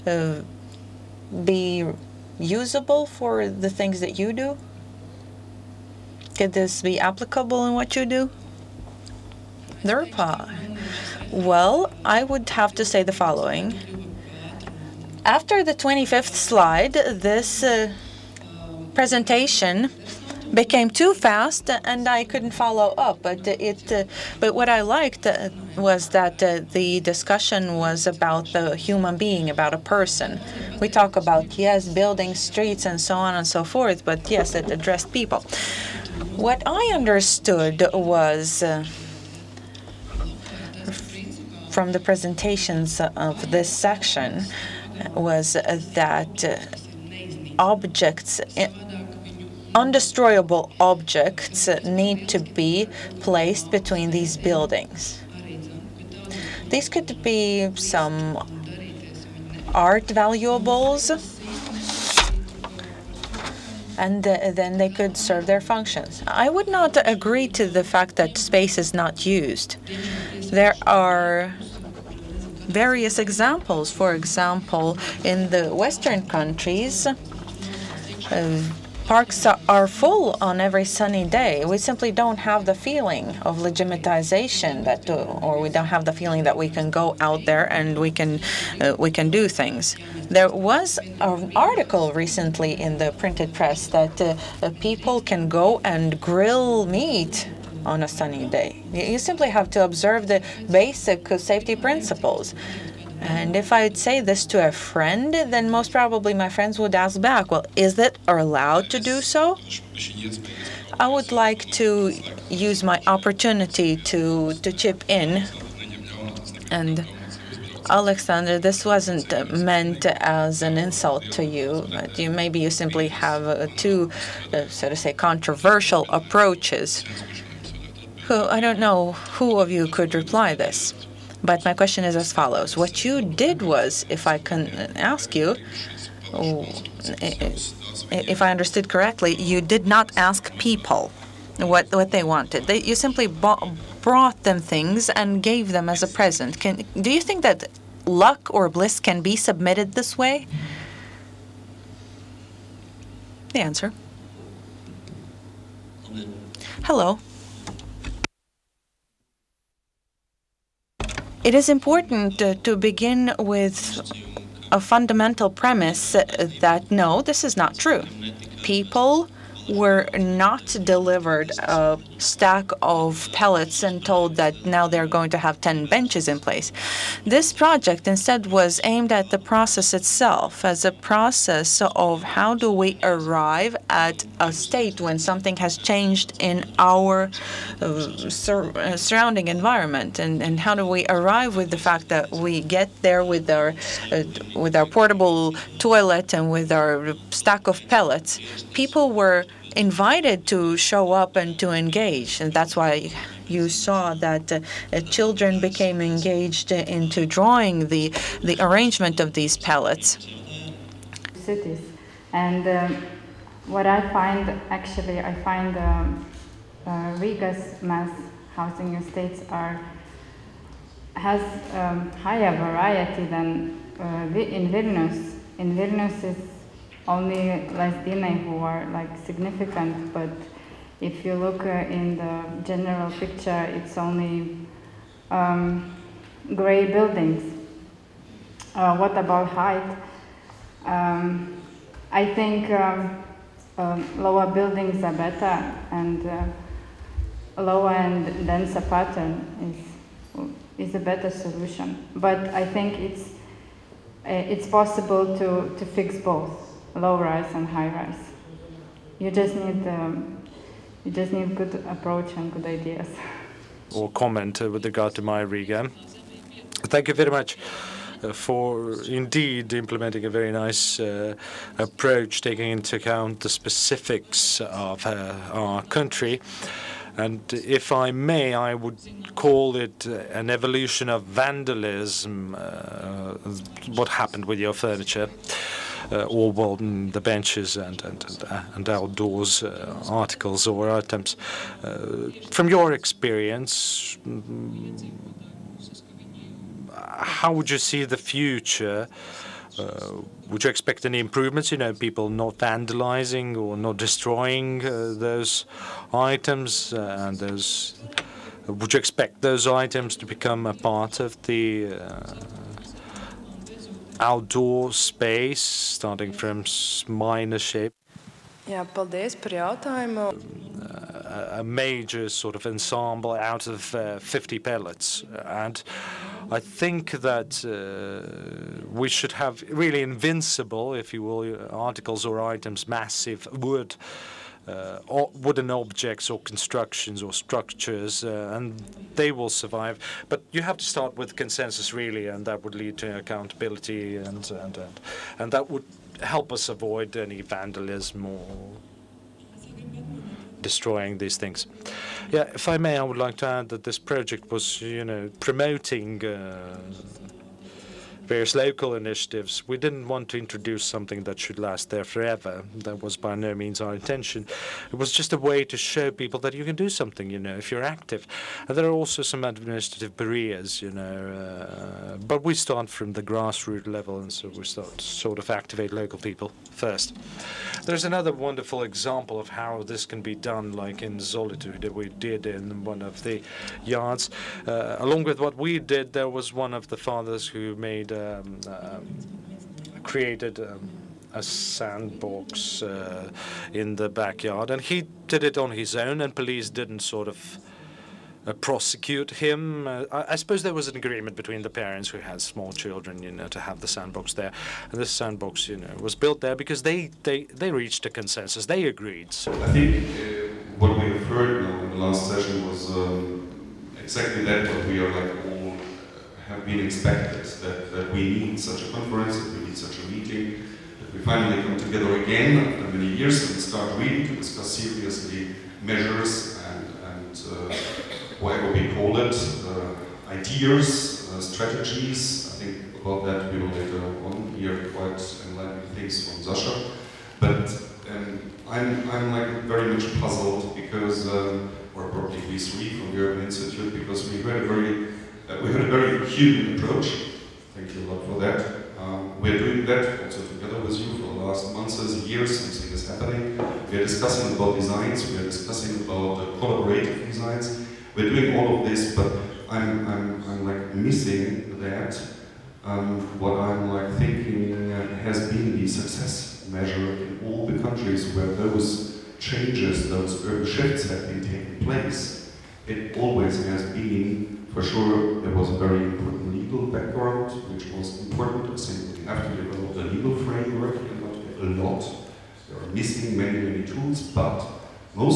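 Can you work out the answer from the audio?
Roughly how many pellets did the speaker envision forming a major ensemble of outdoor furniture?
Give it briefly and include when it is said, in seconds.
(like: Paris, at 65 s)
50, at 324 s.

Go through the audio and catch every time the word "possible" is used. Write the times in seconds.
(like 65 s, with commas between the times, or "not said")
254 s.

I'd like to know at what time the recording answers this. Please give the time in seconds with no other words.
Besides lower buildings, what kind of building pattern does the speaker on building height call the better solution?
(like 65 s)
248 s.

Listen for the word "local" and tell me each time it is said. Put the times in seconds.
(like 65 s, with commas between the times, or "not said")
358 s, 375 s.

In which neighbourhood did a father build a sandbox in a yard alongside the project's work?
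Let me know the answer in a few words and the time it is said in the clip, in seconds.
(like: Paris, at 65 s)
Zolitūde, at 381 s.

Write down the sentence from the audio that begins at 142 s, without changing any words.
They, you simply brought them things and gave them as a present.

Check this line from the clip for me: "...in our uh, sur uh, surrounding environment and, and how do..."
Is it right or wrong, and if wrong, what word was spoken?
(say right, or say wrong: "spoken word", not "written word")
right.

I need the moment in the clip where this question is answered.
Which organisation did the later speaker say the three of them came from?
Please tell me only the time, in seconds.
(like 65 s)
443 s.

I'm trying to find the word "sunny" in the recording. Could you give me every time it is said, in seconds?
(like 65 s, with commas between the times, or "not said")
80 s, 98 s.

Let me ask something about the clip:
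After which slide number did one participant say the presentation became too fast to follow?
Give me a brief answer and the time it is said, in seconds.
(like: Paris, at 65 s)
25th, at 15 s.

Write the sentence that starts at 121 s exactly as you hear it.
But you maybe you simply have uh, two, uh, so to say, controversial approaches.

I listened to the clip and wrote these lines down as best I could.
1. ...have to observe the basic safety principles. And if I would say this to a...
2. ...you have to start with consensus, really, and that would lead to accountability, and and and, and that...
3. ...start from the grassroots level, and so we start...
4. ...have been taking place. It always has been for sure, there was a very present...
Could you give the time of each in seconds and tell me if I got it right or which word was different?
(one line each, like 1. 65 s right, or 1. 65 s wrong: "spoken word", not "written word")
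1. 99 s right
2. 340 s right
3. 372 s right
4. 471 s wrong: "important", not "present".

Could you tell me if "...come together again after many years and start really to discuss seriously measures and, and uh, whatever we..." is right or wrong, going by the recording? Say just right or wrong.
right.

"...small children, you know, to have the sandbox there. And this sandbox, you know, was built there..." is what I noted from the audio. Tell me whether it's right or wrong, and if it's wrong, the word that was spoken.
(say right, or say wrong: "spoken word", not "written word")
right.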